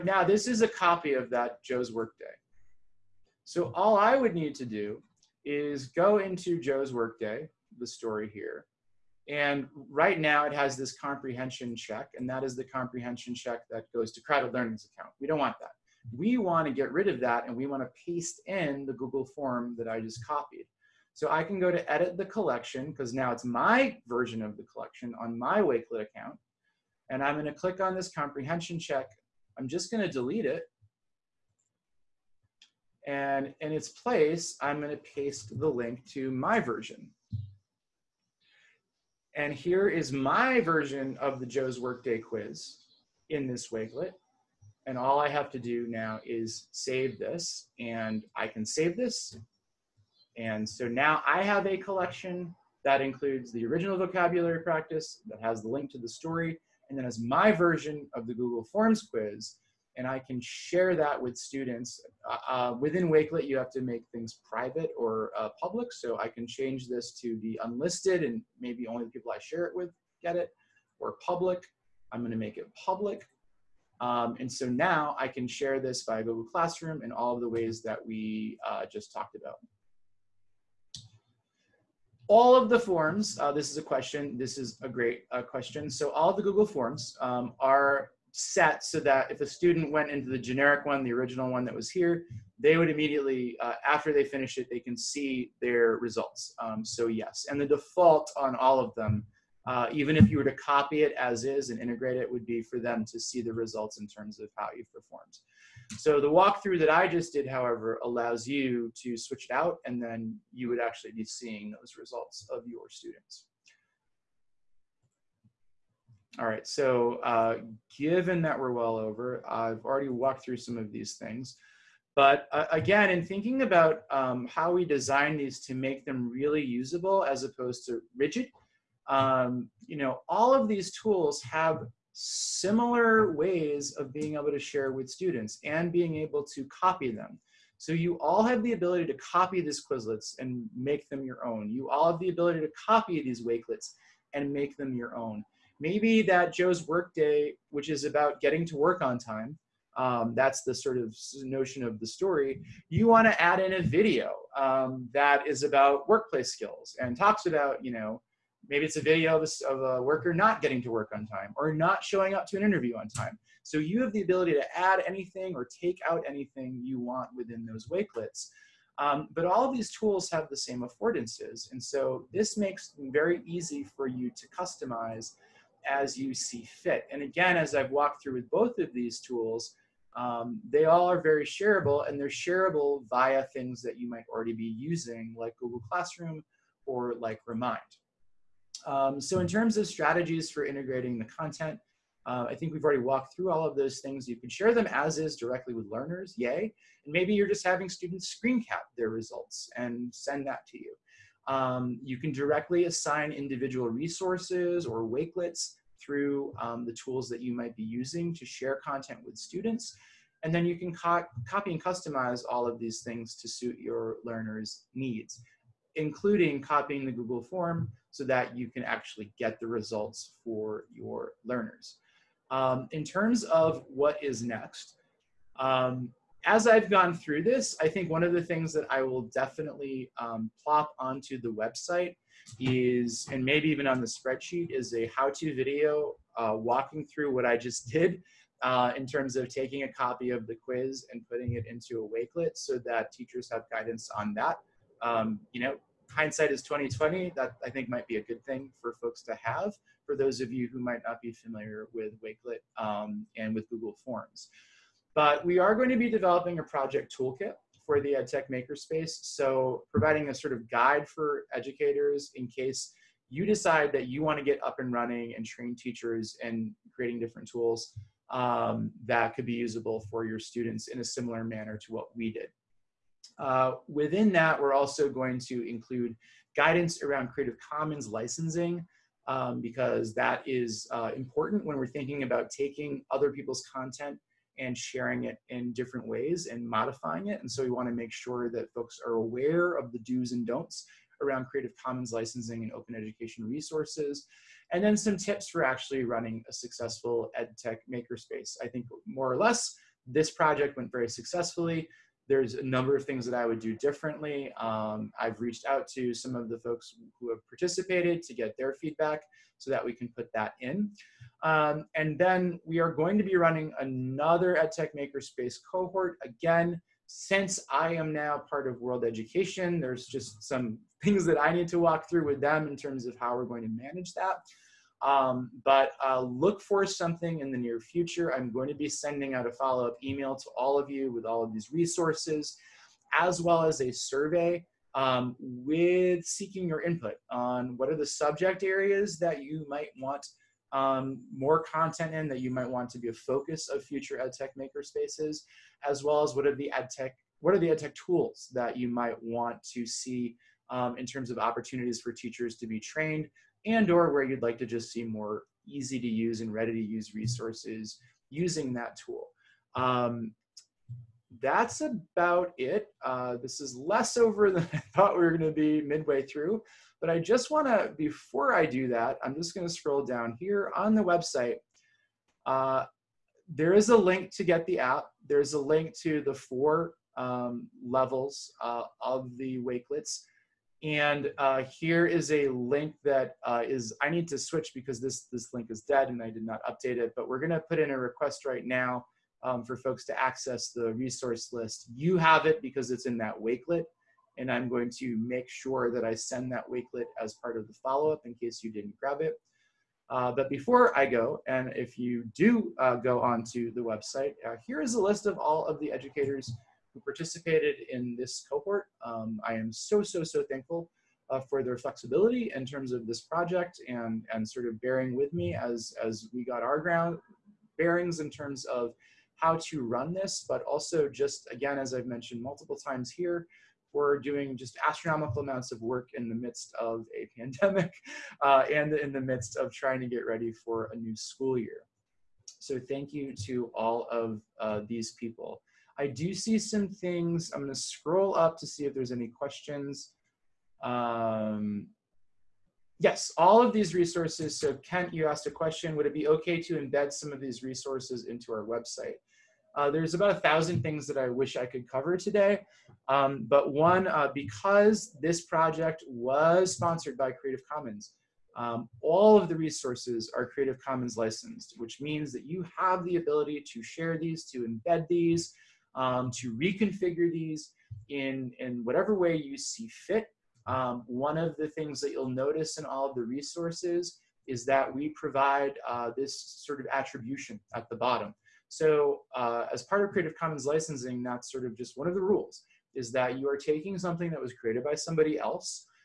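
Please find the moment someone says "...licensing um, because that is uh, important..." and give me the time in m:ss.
4:38.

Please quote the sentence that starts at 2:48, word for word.
Um, but all of these tools have the same affordances.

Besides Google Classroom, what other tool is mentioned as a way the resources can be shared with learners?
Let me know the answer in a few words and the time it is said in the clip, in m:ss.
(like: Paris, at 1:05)
Remind, at 3:07.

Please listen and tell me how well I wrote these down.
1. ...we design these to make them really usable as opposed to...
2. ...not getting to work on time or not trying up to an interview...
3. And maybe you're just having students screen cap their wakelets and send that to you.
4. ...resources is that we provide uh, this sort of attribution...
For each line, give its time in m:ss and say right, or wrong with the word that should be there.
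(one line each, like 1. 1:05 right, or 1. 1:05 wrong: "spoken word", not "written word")
1. 2:04 right
2. 2:40 wrong: "showing", not "trying"
3. 3:17 wrong: "results", not "wakelets"
4. 7:53 right.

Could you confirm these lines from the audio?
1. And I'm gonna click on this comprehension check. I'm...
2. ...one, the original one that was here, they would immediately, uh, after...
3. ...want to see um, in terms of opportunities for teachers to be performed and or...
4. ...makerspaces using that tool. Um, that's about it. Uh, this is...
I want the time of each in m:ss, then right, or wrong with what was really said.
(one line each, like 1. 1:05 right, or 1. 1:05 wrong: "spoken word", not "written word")
1. 0:27 right
2. 1:30 right
3. 5:49 wrong: "trained", not "performed"
4. 5:57 wrong: "resources", not "makerspaces".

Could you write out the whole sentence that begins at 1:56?
All right, so uh, given that we're well over, I've already walked through some of these things.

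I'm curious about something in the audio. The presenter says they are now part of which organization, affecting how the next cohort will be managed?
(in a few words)
World Education.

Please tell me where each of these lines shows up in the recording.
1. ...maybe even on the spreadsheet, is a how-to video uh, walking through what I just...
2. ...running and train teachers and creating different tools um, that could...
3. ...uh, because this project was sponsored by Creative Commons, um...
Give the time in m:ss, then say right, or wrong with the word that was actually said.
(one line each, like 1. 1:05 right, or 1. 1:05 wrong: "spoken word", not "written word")
1. 3:53 right
2. 4:24 right
3. 7:34 right.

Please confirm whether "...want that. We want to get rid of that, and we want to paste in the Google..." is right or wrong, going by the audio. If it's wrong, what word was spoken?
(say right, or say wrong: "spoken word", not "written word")
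right.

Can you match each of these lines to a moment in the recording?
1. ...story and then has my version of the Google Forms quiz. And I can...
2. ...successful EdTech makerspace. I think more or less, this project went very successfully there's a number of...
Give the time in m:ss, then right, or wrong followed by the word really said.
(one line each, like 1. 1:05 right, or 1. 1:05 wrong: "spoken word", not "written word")
1. 0:56 right
2. 4:56 right.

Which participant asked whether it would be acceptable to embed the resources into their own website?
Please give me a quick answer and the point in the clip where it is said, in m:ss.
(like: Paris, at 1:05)
Kent, at 7:24.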